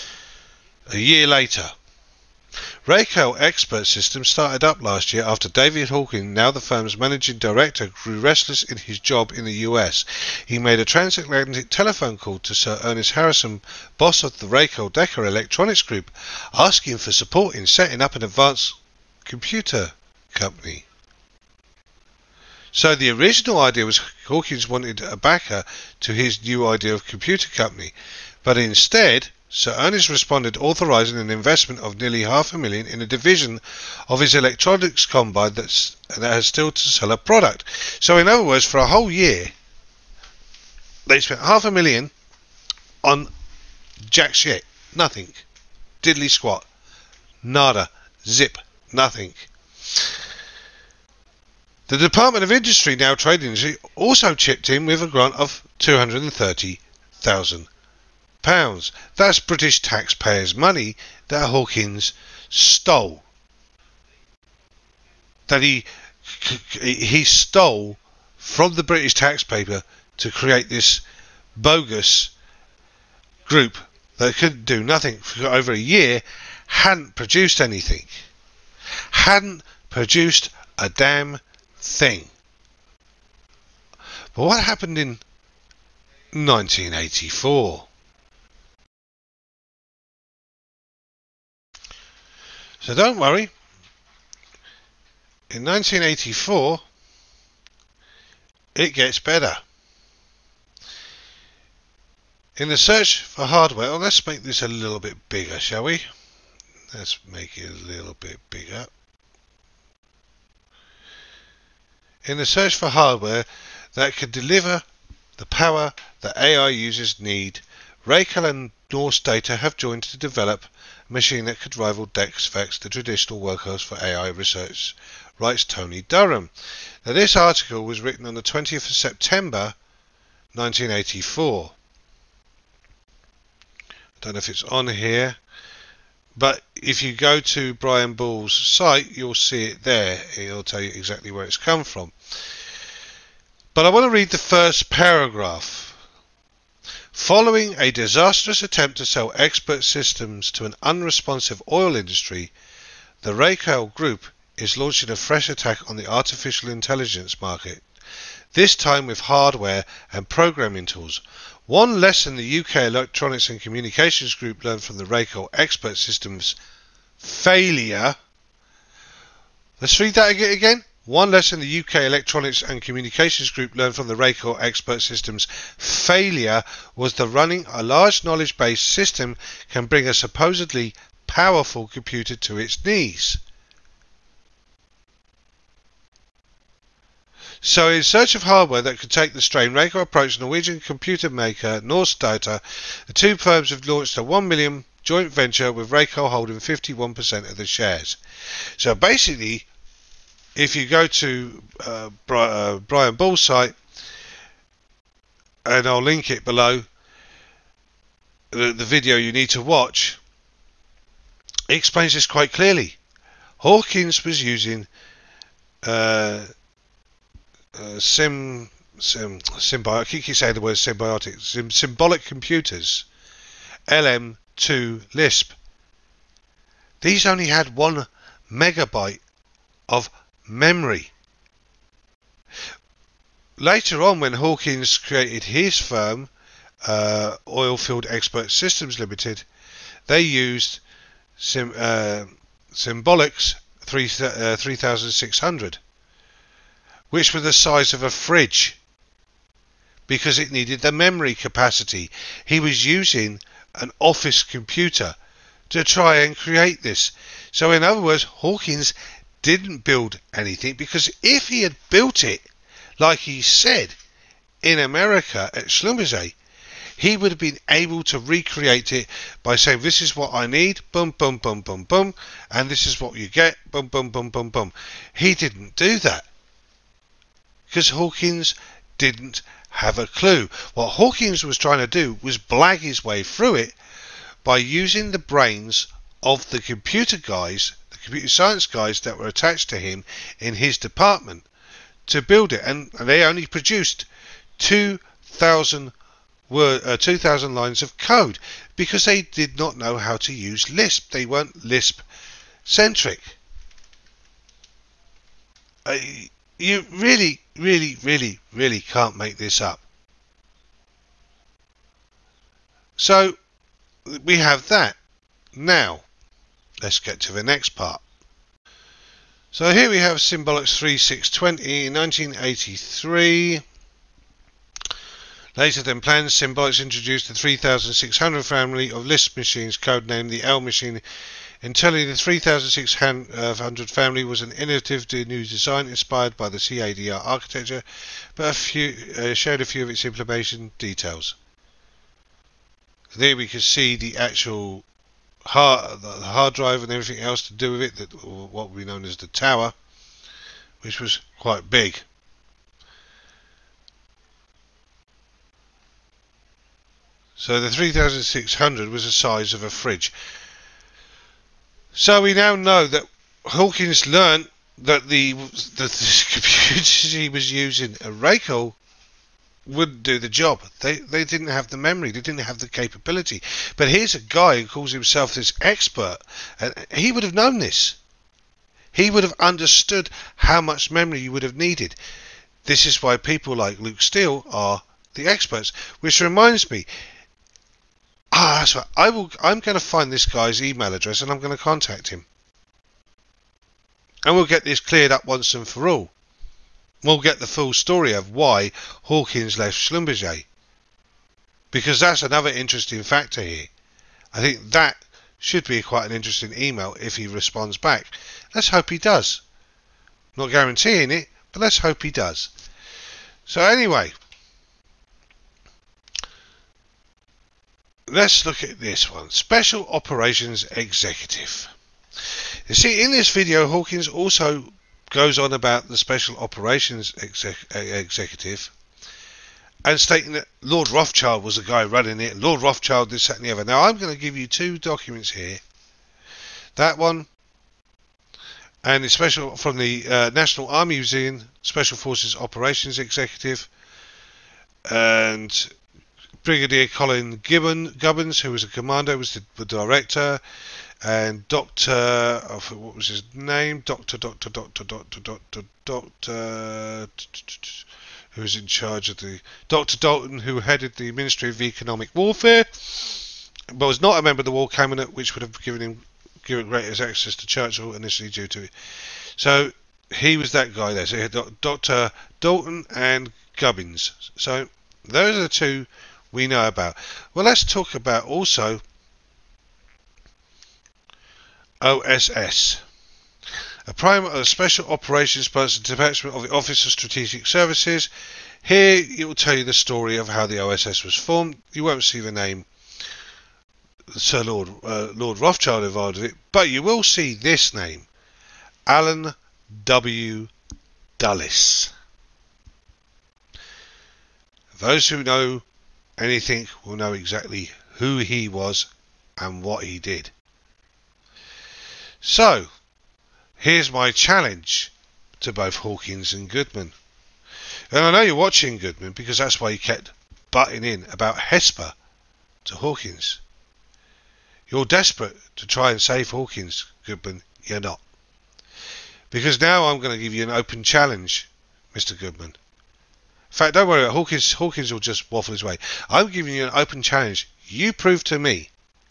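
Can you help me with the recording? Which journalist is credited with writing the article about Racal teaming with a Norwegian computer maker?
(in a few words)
Tony Durham.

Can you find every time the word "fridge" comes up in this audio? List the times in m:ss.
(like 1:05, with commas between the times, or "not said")
4:08, 5:59.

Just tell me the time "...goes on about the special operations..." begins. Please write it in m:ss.
7:05.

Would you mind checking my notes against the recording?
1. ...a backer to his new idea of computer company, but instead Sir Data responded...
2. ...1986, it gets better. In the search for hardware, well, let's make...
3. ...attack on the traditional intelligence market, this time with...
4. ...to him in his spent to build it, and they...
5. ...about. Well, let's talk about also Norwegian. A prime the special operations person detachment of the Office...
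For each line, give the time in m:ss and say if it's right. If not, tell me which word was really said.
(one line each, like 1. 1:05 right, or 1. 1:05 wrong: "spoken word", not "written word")
1. 0:25 wrong: "Ernest", not "Data"
2. 1:35 wrong: "1984", not "1986"
3. 2:35 wrong: "artificial", not "traditional"
4. 4:49 wrong: "department", not "spent"
5. 7:56 wrong: "OSS", not "Norwegian".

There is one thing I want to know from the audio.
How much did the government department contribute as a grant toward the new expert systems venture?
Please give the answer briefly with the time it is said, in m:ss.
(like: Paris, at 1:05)
230,000 pounds, at 0:55.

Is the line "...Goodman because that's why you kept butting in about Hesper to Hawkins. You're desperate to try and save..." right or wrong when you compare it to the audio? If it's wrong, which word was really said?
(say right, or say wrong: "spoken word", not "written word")
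right.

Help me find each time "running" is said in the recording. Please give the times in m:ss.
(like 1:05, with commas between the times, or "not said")
2:57, 7:11.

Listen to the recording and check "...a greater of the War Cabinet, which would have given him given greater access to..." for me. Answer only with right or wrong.
wrong.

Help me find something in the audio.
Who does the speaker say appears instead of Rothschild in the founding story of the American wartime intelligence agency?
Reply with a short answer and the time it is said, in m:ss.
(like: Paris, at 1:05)
Allen W. Dulles, at 8:18.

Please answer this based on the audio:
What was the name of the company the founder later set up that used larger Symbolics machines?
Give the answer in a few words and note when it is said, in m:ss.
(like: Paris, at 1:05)
Oilfield Expert Systems Limited, at 3:57.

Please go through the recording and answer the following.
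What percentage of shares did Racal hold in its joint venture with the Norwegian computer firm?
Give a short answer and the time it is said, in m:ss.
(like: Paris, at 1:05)
51%, at 3:16.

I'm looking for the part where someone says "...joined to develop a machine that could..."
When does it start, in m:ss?
1:59.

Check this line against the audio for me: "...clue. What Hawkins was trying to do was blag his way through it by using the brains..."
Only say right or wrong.
right.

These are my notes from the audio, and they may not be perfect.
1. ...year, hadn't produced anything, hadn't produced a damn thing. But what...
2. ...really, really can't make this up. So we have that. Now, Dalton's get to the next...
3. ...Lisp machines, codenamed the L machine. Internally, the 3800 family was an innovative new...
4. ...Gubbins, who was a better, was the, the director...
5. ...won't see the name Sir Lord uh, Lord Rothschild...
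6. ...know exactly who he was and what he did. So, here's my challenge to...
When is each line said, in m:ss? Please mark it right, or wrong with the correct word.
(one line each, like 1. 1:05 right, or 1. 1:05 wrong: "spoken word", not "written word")
1. 1:15 right
2. 5:08 wrong: "Let", not "Dalton"
3. 5:29 wrong: "3600", not "3800"
4. 7:27 wrong: "commander", not "better"
5. 8:11 right
6. 8:26 right.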